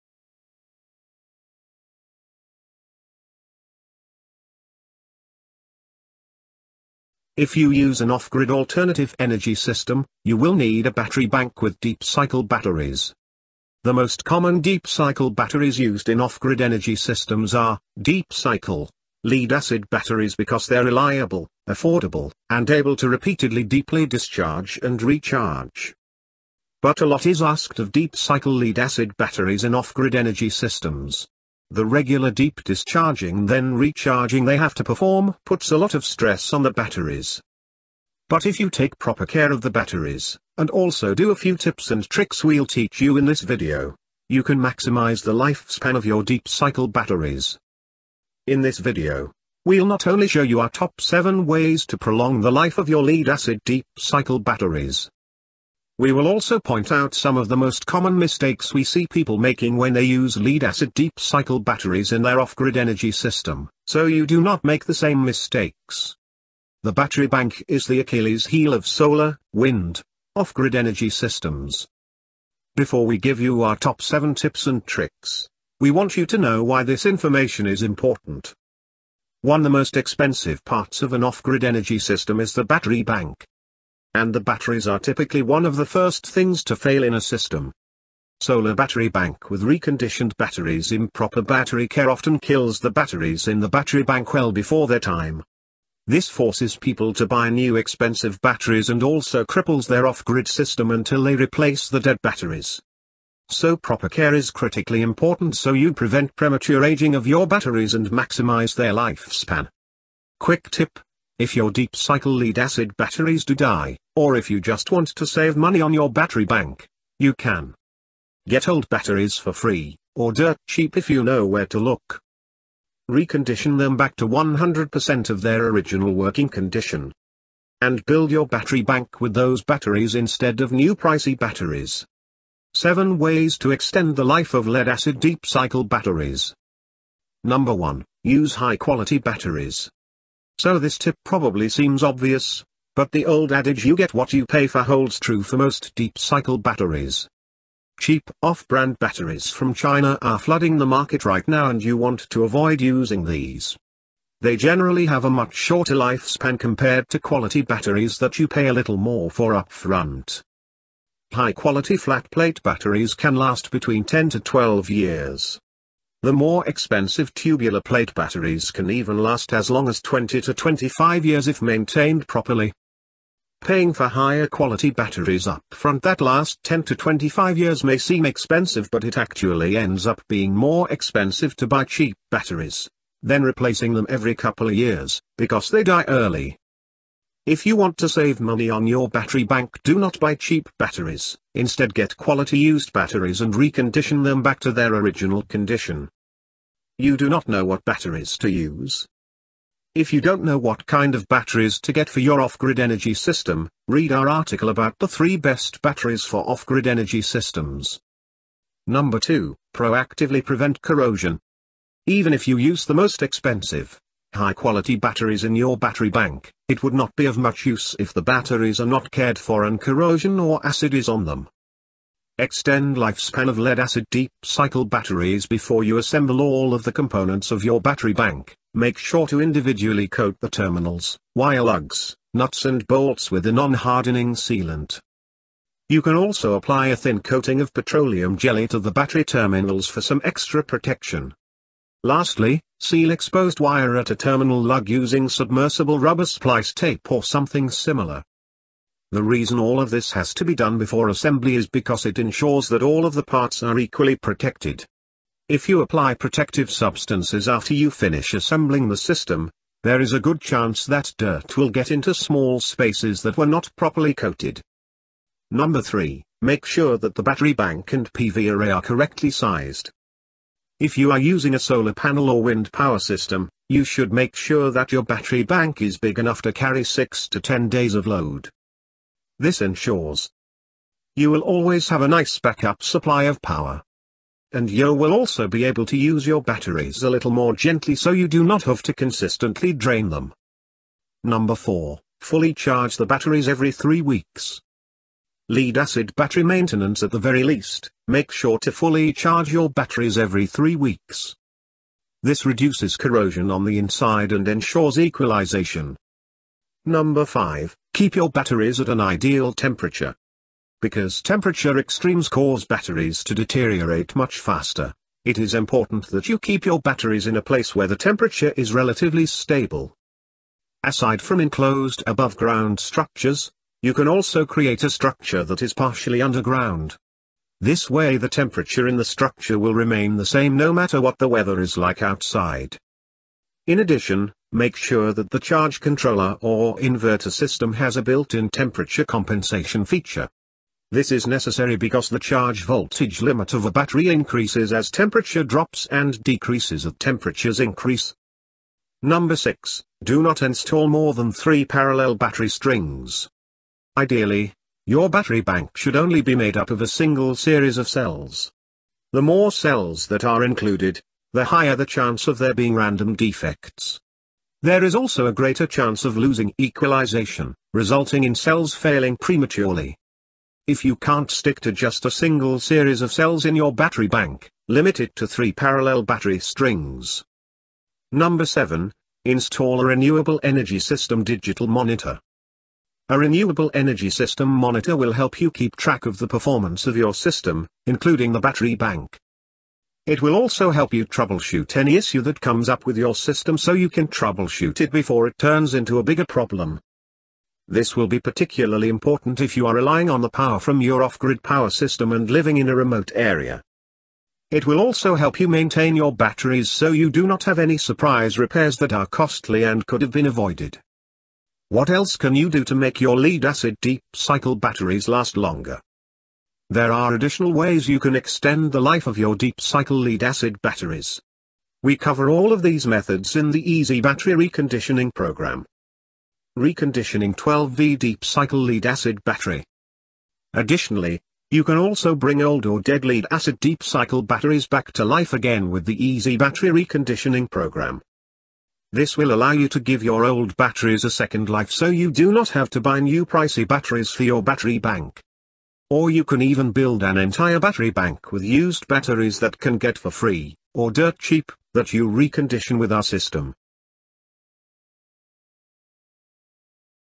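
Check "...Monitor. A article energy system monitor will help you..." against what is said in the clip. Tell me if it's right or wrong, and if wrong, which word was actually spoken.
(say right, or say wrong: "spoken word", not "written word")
wrong: "renewable", not "article".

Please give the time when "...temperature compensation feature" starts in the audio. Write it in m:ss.
5:38.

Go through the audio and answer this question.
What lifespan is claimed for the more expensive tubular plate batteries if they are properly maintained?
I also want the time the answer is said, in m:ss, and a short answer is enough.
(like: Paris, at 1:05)
20 to 25 years, at 2:50.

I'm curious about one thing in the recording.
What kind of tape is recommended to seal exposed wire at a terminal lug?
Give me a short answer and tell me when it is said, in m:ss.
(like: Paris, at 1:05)
Submersible rubber splice tape, at 4:05.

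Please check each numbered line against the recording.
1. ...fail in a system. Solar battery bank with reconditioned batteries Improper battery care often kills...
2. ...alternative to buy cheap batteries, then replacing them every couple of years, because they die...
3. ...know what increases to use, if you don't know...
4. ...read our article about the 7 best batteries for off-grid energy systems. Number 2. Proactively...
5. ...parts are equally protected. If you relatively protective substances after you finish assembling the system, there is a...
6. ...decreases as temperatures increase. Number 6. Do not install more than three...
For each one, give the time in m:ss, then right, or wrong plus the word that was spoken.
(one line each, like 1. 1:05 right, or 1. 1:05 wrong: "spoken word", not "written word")
1. 1:26 right
2. 3:00 wrong: "expensive", not "alternative"
3. 3:17 wrong: "batteries", not "increases"
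4. 3:23 wrong: "3", not "7"
5. 4:13 wrong: "apply", not "relatively"
6. 5:46 right.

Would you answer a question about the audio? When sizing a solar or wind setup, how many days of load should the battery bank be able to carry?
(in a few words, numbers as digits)
6 to 10 days.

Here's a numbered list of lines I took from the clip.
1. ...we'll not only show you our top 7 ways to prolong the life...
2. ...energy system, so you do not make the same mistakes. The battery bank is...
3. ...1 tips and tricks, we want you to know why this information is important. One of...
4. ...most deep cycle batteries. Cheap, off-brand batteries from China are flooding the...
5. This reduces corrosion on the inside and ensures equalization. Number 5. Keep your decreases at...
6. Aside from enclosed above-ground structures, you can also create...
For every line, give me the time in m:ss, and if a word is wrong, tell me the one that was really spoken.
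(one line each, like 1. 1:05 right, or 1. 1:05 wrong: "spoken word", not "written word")
1. 0:49 right
2. 1:02 right
3. 1:14 wrong: "7", not "1"
4. 2:25 right
5. 5:02 wrong: "batteries", not "decreases"
6. 5:20 right.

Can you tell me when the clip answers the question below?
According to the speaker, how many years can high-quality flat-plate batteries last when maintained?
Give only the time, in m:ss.
2:44.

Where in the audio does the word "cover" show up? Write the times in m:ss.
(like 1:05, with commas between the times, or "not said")
7:01.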